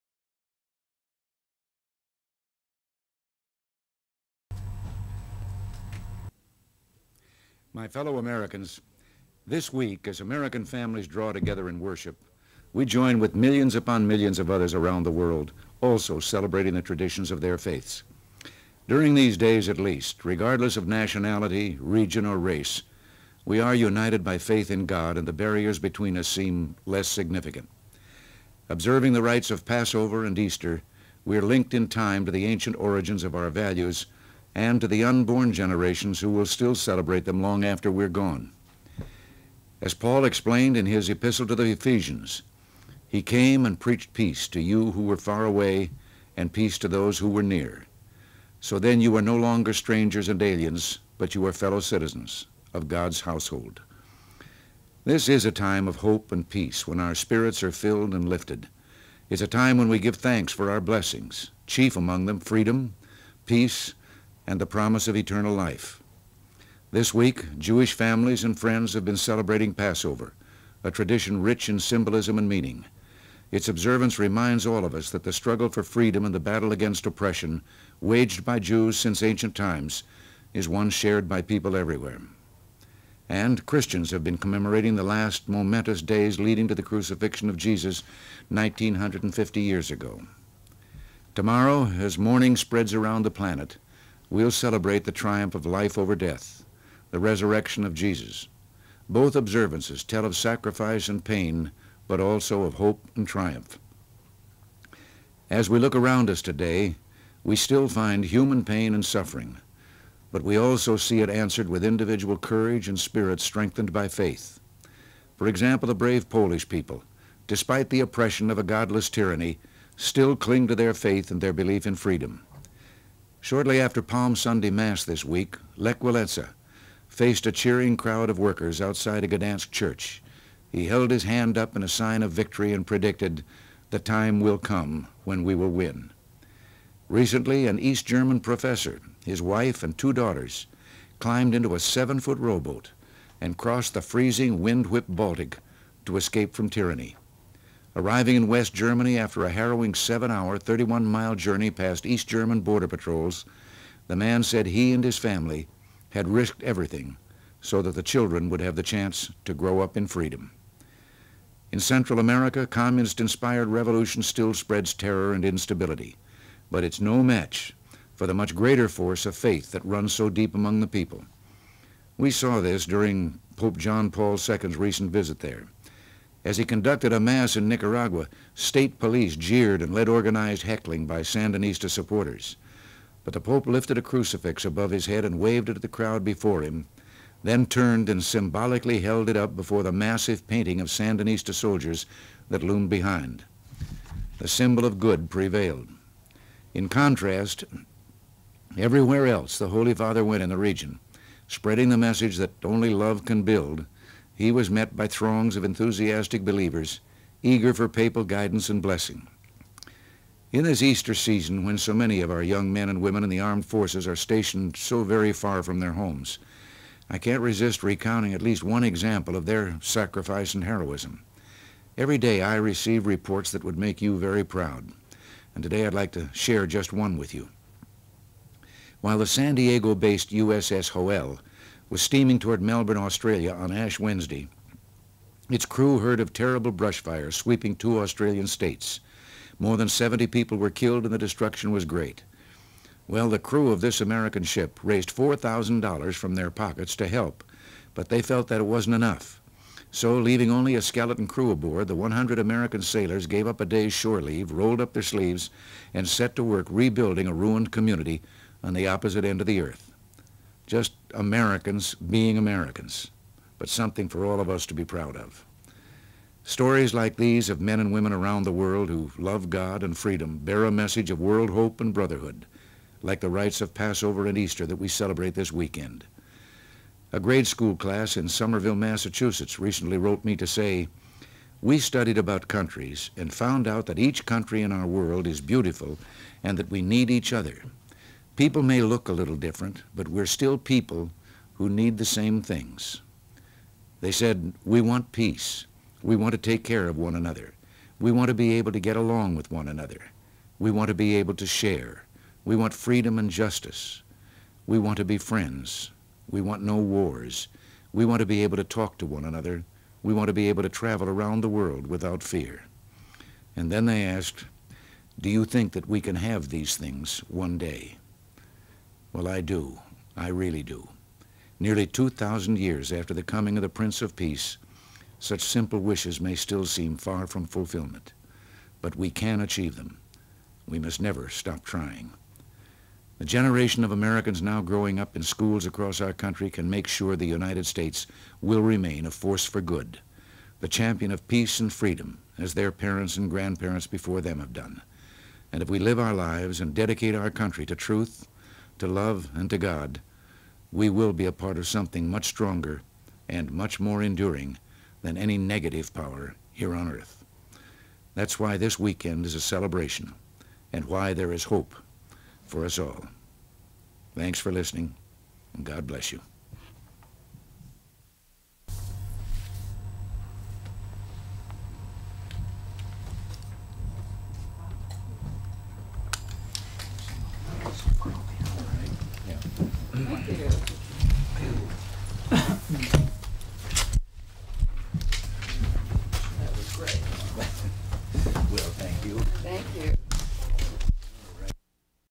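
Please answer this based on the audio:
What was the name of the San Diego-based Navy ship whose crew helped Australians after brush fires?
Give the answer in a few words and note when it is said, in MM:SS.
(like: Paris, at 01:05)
USS Hoel, at 03:50.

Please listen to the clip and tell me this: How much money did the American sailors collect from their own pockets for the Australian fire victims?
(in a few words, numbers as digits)
$4,000.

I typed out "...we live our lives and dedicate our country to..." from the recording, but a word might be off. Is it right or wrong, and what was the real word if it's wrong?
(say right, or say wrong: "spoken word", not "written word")
right.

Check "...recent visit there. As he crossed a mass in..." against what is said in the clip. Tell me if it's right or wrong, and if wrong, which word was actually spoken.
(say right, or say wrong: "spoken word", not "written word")
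wrong: "conducted", not "crossed".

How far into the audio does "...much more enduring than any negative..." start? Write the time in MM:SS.
05:53.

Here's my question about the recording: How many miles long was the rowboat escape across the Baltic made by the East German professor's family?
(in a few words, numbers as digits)
31.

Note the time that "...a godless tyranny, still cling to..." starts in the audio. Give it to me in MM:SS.
01:58.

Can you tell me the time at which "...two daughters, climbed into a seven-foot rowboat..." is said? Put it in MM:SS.
02:19.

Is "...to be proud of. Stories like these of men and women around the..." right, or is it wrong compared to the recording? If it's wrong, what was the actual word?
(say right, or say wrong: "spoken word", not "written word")
right.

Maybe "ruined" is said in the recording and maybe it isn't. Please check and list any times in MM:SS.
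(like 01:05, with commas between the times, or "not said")
04:17.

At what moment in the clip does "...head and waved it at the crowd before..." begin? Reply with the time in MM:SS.
03:05.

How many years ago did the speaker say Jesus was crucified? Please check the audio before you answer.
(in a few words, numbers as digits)
1950.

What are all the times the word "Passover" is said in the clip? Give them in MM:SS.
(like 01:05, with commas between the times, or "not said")
00:29, 01:09, 04:33.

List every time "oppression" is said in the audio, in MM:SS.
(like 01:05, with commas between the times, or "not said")
01:17, 01:57.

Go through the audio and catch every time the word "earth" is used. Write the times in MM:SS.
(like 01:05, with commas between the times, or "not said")
04:19, 05:56.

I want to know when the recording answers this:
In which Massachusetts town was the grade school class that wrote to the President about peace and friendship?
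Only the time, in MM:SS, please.
04:38.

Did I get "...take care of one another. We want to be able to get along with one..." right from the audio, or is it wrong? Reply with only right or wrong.
right.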